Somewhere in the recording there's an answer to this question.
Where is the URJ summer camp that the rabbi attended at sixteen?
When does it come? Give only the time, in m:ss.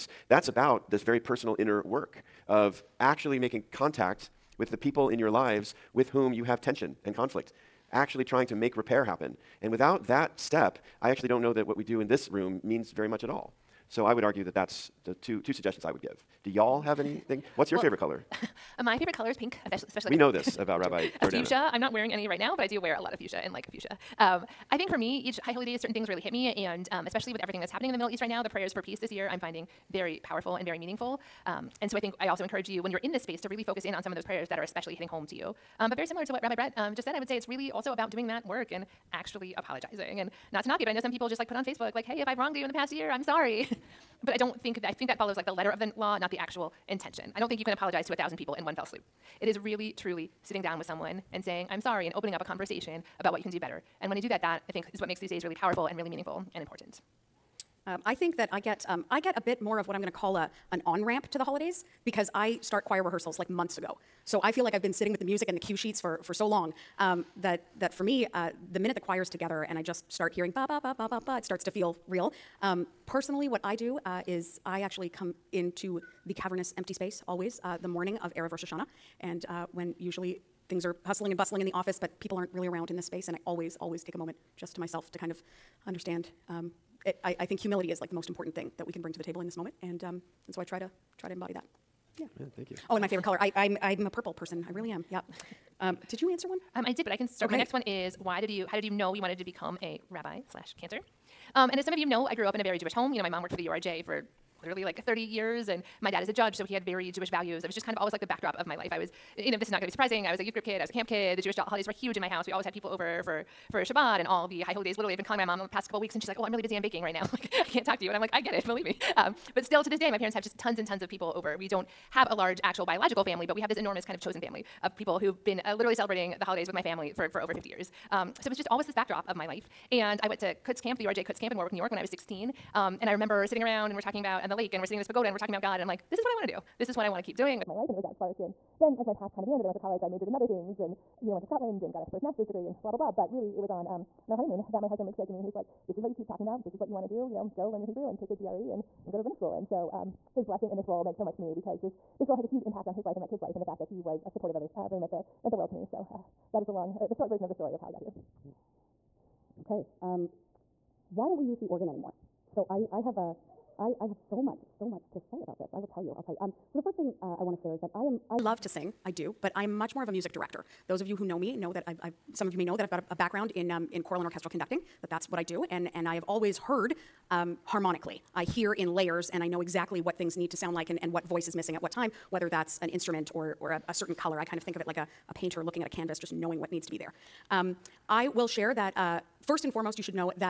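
2:11.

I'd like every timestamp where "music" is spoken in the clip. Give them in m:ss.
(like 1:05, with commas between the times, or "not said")
1:05, 2:50.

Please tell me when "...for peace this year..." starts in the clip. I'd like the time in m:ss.
0:28.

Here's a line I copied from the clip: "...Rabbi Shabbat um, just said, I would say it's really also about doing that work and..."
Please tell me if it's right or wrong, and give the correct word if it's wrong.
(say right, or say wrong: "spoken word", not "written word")
wrong: "Brett", not "Shabbat".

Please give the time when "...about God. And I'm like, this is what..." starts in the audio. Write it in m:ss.
2:15.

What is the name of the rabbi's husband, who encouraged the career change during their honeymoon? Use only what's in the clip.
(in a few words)
Luke.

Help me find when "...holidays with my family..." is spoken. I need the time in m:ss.
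2:06.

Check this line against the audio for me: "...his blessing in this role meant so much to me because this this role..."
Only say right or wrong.
right.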